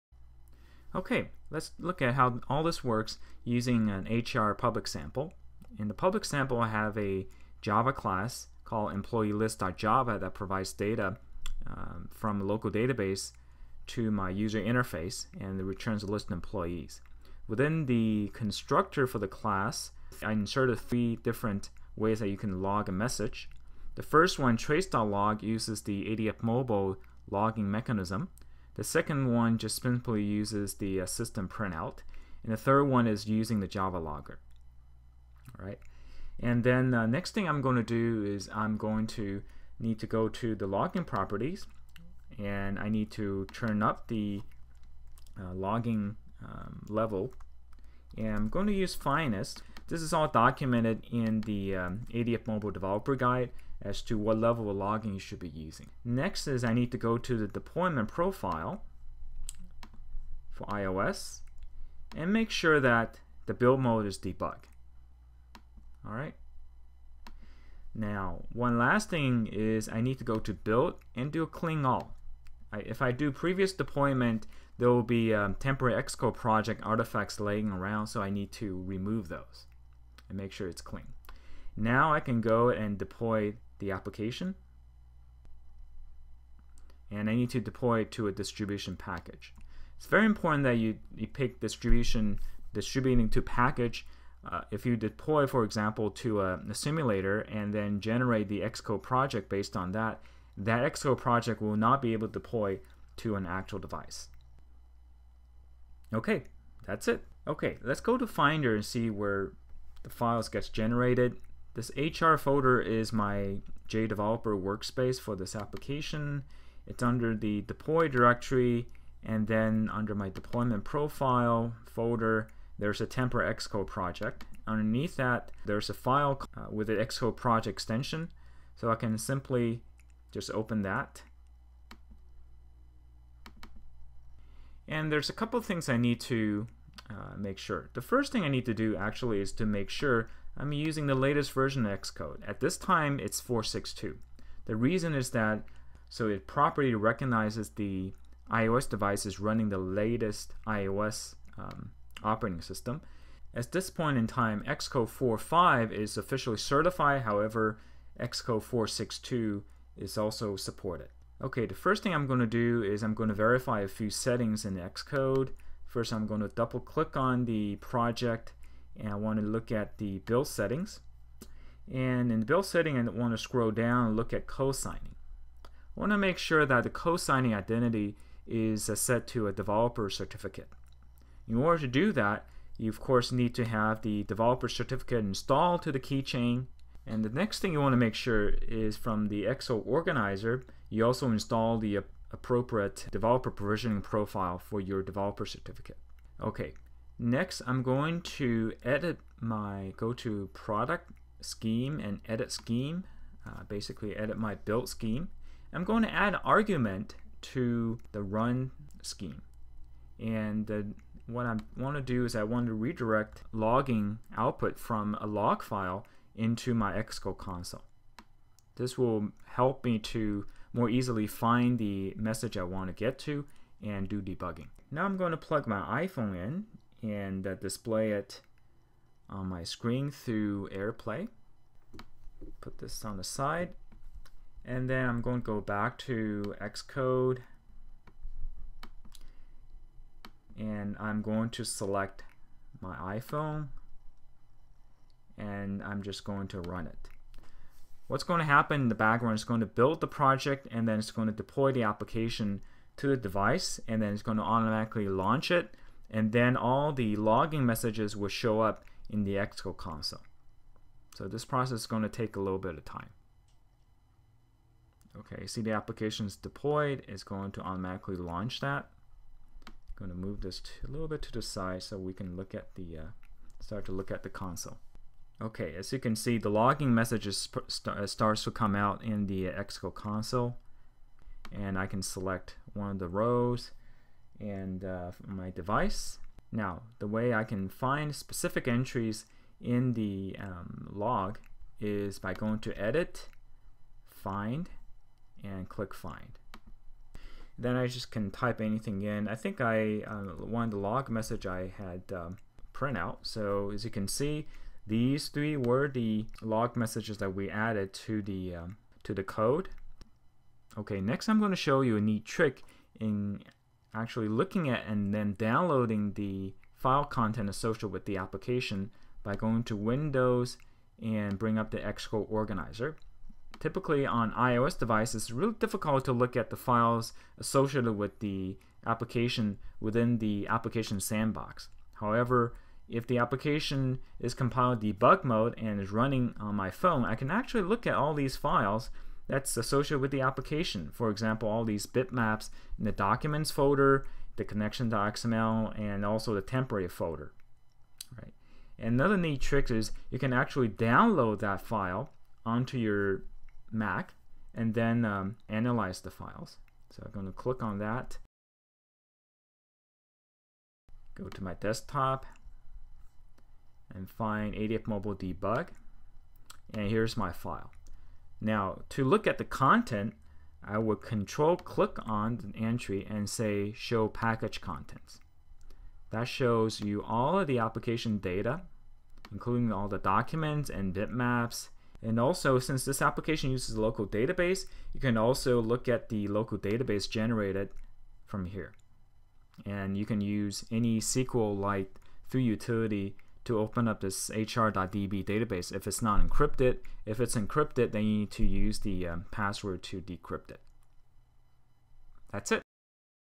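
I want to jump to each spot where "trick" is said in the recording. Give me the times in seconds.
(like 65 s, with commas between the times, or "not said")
312 s, 349 s.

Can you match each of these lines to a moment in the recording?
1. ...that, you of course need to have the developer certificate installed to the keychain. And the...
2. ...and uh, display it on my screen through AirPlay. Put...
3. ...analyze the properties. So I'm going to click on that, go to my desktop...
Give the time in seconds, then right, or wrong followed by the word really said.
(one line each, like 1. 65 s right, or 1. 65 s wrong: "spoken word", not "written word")
1. 182 s right
2. 227 s right
3. 355 s wrong: "files", not "properties".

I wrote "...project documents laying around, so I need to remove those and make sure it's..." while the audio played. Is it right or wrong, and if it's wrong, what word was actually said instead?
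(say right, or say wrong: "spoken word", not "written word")
wrong: "artifacts", not "documents".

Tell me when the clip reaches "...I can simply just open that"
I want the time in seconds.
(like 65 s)
128 s.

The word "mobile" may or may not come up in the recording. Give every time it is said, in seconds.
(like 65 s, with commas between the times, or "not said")
26 s, 52 s, 364 s.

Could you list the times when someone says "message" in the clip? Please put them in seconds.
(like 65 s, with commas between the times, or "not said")
22 s, 222 s, 257 s, 276 s, 301 s, 306 s.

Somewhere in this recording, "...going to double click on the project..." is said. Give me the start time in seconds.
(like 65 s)
166 s.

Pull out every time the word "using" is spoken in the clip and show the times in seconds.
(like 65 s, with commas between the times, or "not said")
3 s, 33 s, 55 s, 140 s.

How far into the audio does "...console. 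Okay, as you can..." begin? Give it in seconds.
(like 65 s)
274 s.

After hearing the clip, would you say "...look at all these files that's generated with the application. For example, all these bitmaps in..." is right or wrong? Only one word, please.
wrong.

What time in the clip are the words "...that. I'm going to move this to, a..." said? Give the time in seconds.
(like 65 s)
268 s.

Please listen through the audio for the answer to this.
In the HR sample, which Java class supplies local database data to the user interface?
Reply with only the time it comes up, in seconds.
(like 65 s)
8 s.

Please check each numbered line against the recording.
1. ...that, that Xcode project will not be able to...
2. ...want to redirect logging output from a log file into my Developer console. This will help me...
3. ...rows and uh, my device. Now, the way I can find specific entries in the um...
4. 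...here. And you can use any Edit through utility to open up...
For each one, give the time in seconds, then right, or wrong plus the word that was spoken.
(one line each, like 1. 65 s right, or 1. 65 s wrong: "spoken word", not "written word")
1. 99 s right
2. 212 s wrong: "Xcode", not "Developer"
3. 283 s right
4. 388 s wrong: "SQLite", not "Edit".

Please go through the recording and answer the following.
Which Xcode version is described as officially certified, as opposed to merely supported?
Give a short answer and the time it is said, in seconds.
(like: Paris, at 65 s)
Xcode 4.5, at 154 s.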